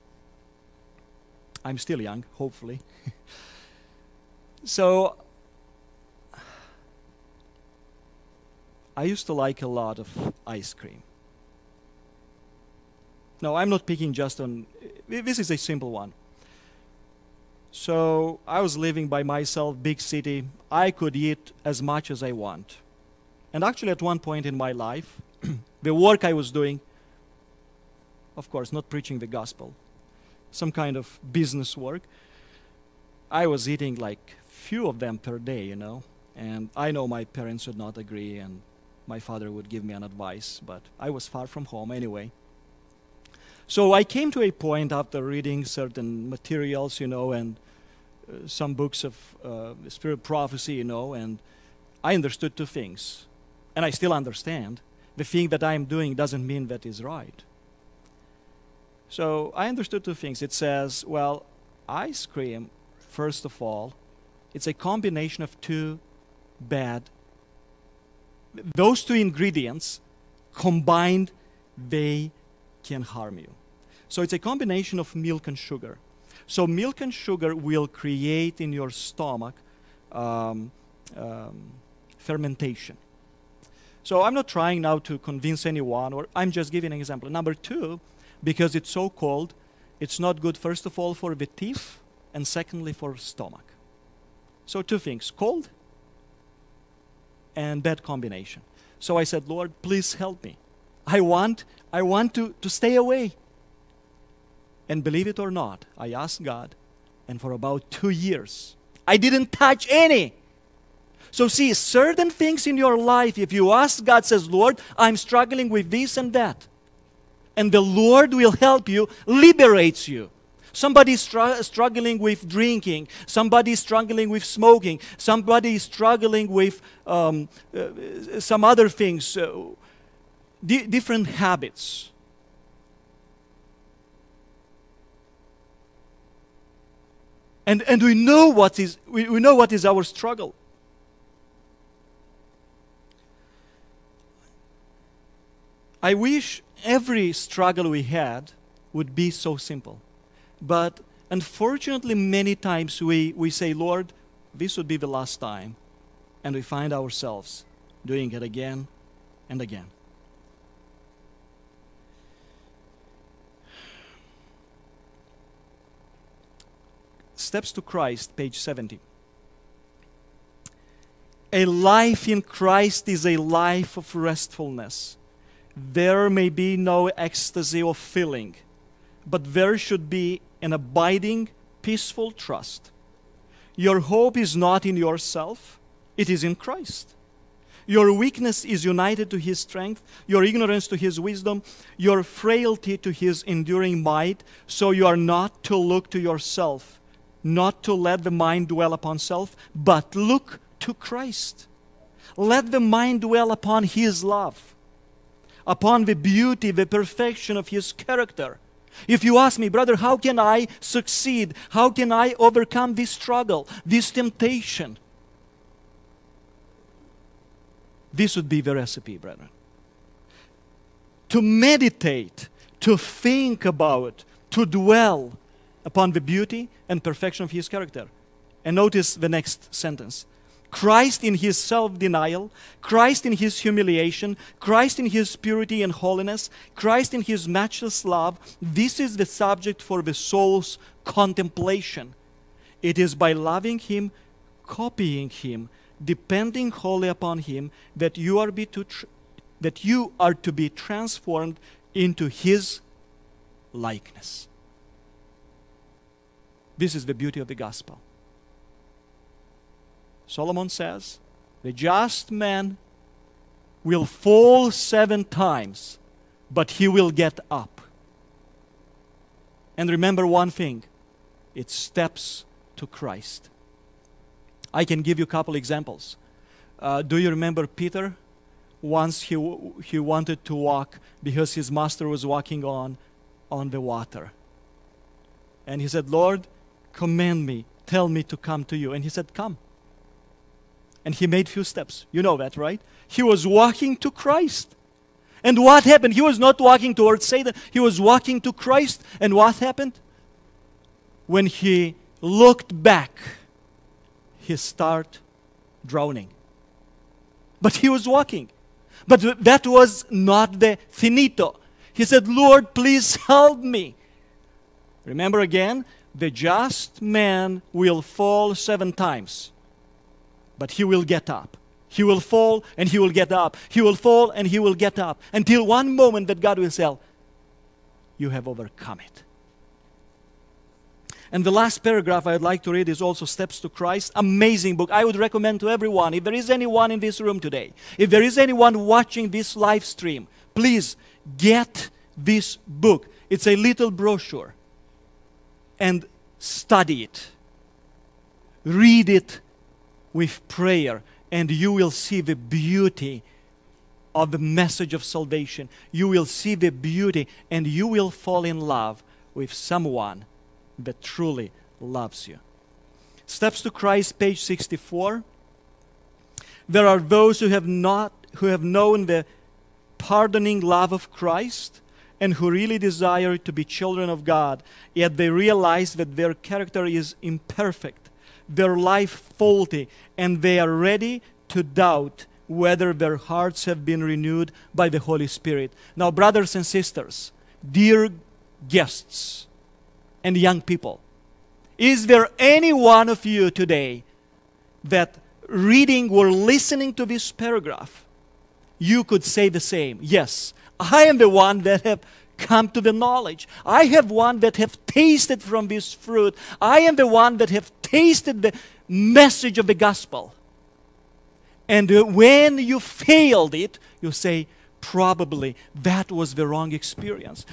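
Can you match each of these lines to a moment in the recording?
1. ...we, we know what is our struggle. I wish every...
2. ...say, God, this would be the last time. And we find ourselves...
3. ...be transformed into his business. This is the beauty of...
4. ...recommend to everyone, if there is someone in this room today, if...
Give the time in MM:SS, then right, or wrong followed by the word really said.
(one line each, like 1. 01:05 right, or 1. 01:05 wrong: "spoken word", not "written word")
1. 02:19 right
2. 02:33 wrong: "Lord", not "God"
3. 04:10 wrong: "likeness", not "business"
4. 05:35 wrong: "anyone", not "someone".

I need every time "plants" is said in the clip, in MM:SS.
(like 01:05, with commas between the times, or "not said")
not said.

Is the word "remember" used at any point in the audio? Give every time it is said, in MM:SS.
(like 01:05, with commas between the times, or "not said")
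04:29, 04:37, 05:15.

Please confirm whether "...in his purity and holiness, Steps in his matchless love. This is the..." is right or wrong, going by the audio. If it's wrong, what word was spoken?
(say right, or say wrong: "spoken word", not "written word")
wrong: "Christ", not "Steps".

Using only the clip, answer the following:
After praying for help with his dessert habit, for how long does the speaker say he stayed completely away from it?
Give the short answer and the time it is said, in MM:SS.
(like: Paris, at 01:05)
2 years, at 01:47.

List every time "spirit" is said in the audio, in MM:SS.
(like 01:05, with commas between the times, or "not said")
00:49, 06:25.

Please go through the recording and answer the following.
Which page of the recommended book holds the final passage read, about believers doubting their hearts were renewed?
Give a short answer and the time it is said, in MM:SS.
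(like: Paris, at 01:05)
64, at 06:04.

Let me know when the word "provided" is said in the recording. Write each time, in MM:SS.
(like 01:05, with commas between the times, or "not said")
not said.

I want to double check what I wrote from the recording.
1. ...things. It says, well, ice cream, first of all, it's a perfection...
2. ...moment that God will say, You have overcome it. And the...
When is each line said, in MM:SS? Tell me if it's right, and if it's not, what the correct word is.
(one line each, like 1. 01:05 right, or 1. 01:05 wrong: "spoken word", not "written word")
1. 01:00 wrong: "combination", not "perfection"
2. 05:25 right.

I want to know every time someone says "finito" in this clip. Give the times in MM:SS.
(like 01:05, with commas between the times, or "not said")
05:10.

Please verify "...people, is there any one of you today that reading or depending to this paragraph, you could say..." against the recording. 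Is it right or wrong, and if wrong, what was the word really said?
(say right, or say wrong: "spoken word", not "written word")
wrong: "listening", not "depending".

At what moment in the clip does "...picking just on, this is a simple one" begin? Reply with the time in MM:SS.
00:13.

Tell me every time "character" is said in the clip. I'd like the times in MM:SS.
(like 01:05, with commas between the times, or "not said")
03:27, 03:47, 06:16.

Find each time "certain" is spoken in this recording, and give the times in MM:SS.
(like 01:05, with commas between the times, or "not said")
00:45, 01:51.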